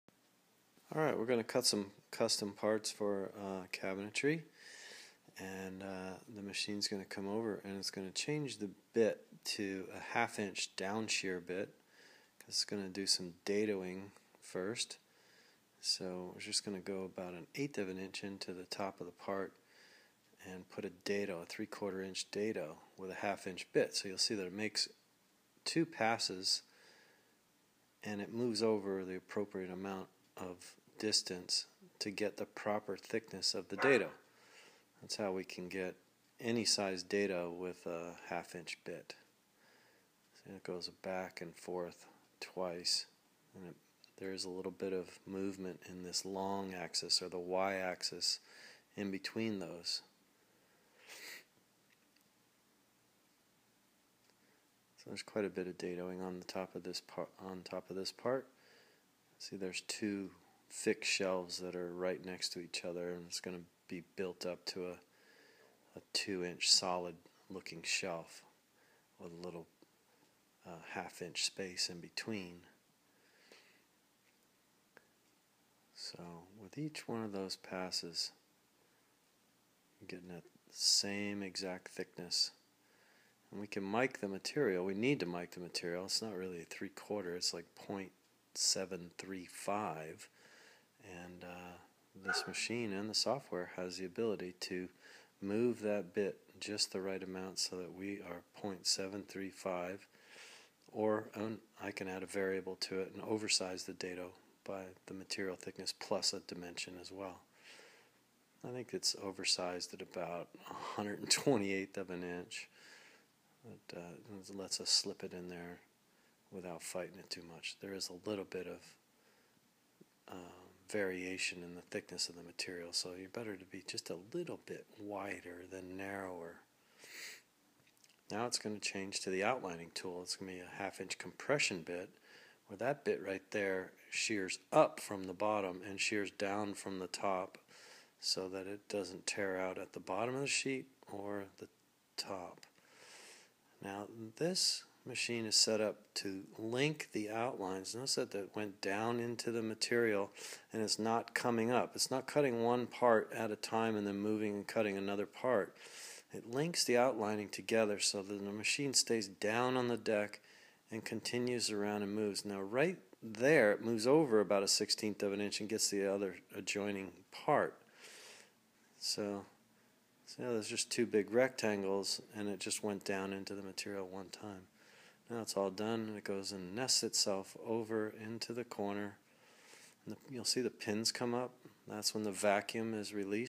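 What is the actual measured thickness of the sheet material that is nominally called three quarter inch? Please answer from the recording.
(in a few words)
0.735.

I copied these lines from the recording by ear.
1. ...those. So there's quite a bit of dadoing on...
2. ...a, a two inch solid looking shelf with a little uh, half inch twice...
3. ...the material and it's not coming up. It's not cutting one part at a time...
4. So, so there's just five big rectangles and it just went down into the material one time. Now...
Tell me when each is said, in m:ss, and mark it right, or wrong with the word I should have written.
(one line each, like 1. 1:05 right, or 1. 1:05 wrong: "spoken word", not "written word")
1. 0:49 right
2. 1:04 wrong: "space", not "twice"
3. 2:29 right
4. 2:48 wrong: "two", not "five".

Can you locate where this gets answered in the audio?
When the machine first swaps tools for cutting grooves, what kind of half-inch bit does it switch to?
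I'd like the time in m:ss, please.
0:10.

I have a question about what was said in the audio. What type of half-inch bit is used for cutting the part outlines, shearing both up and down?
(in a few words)
compression bit.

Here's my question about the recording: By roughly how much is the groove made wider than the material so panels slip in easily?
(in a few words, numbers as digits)
1/128 of an inch.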